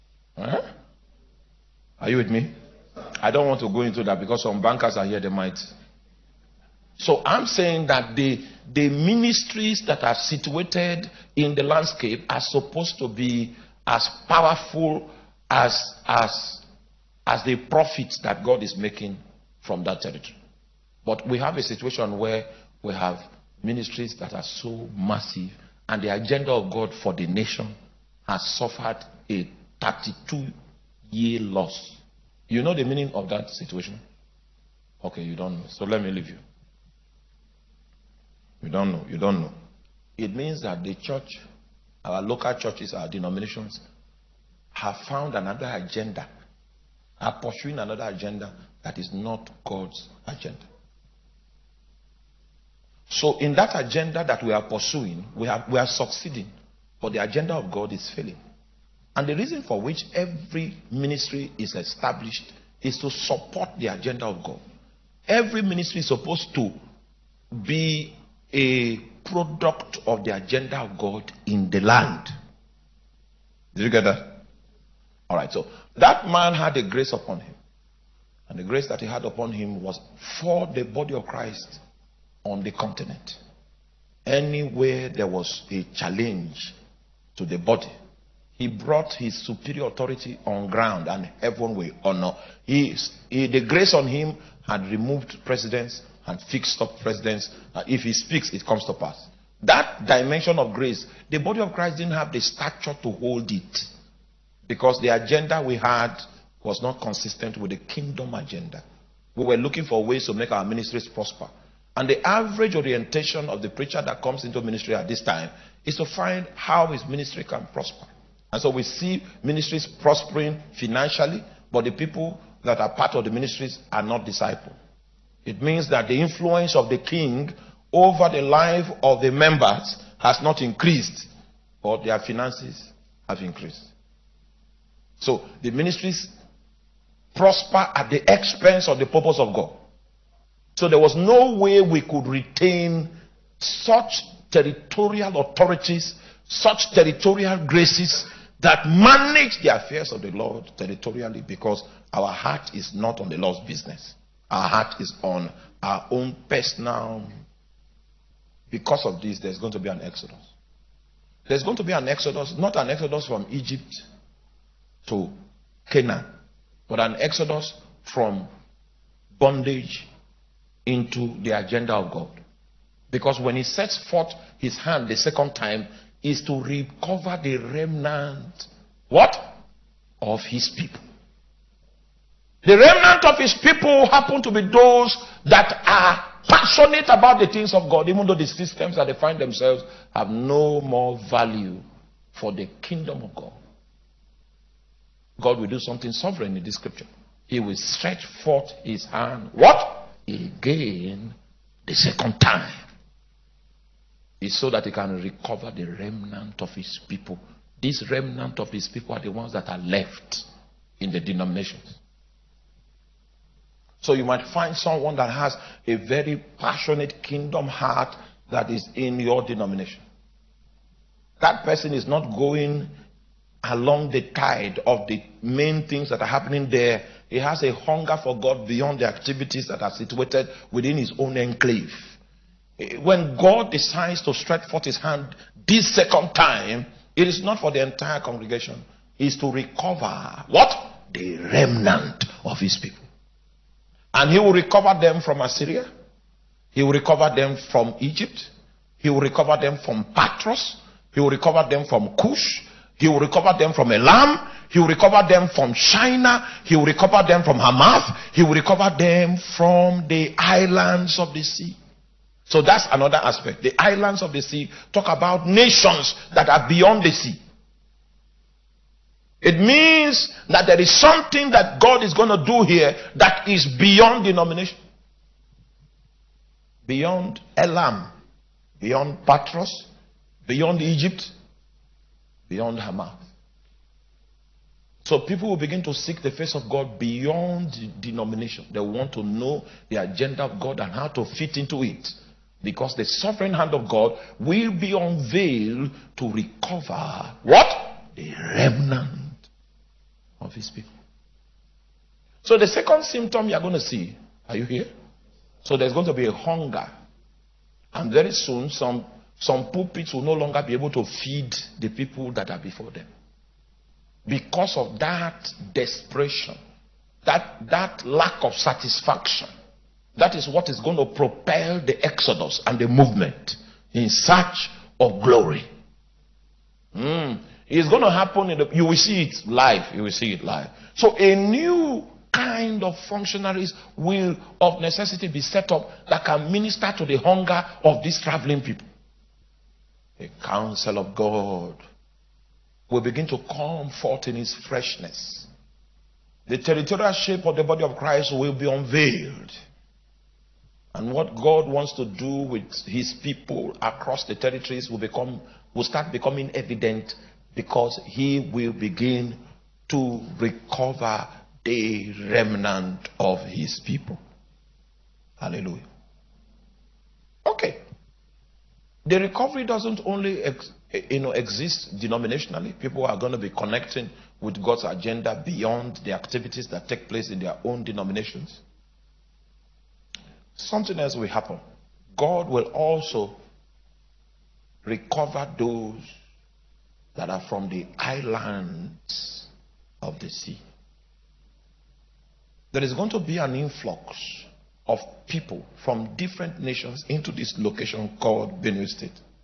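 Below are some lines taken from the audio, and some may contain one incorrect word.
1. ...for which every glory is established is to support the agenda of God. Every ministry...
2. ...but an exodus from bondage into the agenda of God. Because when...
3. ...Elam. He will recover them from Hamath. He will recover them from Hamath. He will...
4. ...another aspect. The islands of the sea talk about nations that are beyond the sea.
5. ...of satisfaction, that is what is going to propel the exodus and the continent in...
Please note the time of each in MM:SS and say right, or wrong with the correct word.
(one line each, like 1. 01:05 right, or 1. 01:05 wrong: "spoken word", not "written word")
1. 00:59 wrong: "ministry", not "glory"
2. 02:46 right
3. 04:13 wrong: "Shinar", not "Hamath"
4. 04:22 right
5. 05:18 wrong: "movement", not "continent".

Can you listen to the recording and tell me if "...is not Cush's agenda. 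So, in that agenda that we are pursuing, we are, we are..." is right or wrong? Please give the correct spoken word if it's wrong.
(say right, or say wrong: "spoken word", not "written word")
wrong: "God", not "Cush".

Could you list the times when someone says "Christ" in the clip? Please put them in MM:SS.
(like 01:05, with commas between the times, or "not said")
01:21, 01:41, 05:47.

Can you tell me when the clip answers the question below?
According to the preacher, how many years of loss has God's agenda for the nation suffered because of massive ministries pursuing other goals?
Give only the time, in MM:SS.
00:29.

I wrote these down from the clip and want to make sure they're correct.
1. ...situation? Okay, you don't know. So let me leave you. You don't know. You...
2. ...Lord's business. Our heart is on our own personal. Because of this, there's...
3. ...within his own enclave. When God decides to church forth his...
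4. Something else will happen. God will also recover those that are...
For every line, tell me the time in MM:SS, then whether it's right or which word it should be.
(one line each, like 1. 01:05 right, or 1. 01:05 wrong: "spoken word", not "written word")
1. 00:33 right
2. 02:33 right
3. 03:50 wrong: "stretch", not "church"
4. 06:20 right.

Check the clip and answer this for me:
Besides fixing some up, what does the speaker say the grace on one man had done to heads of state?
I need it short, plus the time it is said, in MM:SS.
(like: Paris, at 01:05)
Removed presidents, at 01:34.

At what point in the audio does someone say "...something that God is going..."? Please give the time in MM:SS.
04:30.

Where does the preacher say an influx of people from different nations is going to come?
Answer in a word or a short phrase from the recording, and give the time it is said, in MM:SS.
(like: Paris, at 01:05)
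Benue State, at 06:38.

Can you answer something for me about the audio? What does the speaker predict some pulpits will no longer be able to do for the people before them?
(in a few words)
Feed the people.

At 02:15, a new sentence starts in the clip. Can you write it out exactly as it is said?
So the ministries prosper at the expense of the purpose of God.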